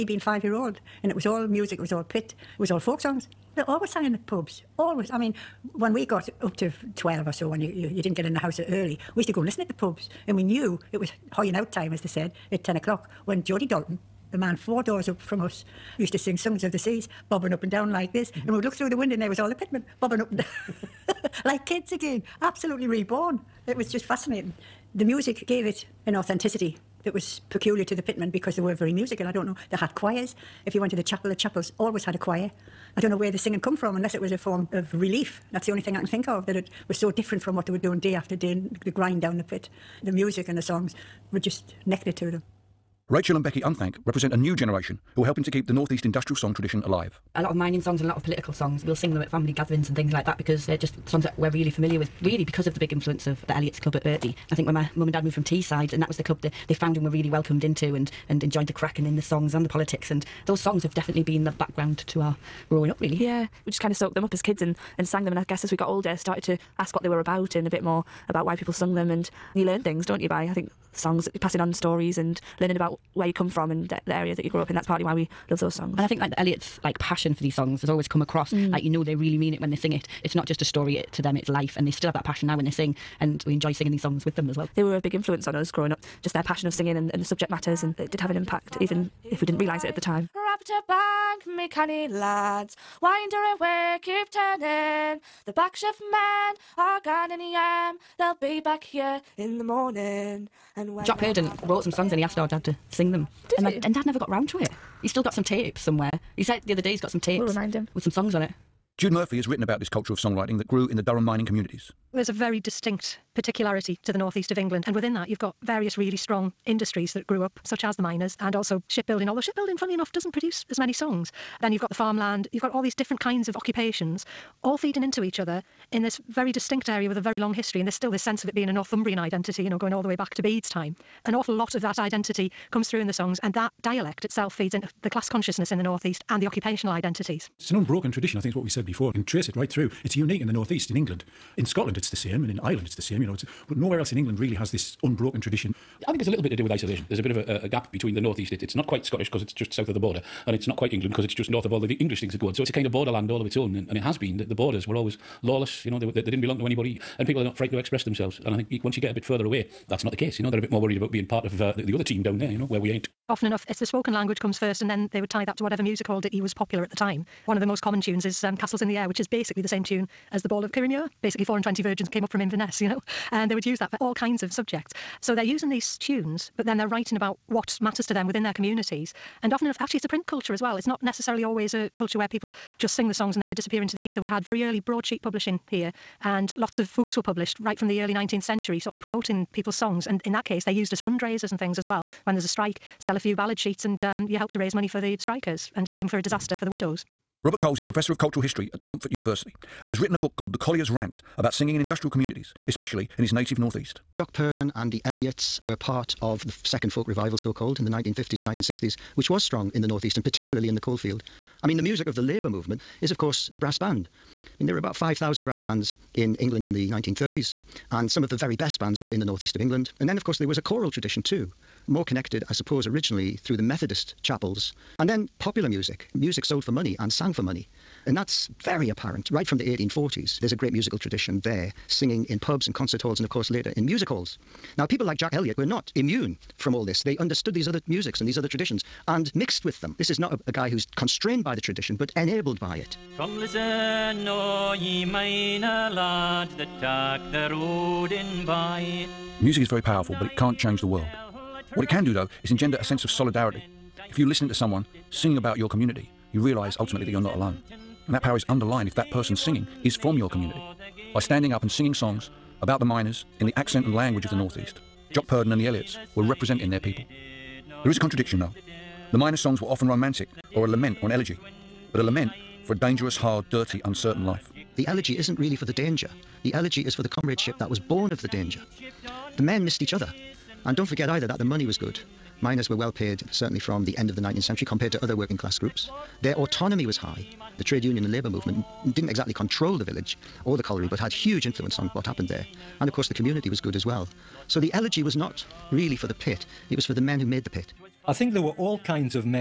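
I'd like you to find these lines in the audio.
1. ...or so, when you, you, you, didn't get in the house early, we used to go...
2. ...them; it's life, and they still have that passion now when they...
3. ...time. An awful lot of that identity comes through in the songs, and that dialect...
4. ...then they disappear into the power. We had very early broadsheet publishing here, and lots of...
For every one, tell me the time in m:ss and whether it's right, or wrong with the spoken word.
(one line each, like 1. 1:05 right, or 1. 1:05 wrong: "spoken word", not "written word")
1. 0:07 right
2. 1:21 right
3. 2:10 right
4. 3:03 wrong: "ether", not "power".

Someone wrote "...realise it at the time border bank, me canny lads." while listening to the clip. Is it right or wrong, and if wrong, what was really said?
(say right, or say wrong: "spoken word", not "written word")
wrong: "chapter", not "border".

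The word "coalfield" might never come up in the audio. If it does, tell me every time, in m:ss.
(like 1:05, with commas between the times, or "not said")
3:30.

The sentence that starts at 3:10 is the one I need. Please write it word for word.
And in that case, they're used as fundraisers and things as well.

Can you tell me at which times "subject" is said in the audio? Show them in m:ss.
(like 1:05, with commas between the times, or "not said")
1:27, 2:54.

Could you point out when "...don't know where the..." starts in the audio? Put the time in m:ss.
0:33.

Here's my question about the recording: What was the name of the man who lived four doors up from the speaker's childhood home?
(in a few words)
Jody Dalton.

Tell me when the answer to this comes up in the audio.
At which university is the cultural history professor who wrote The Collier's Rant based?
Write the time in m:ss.
3:18.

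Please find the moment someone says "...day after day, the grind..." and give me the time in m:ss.
0:37.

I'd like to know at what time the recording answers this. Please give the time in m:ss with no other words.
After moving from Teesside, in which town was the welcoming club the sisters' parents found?
0:54.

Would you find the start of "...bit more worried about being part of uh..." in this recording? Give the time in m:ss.
2:40.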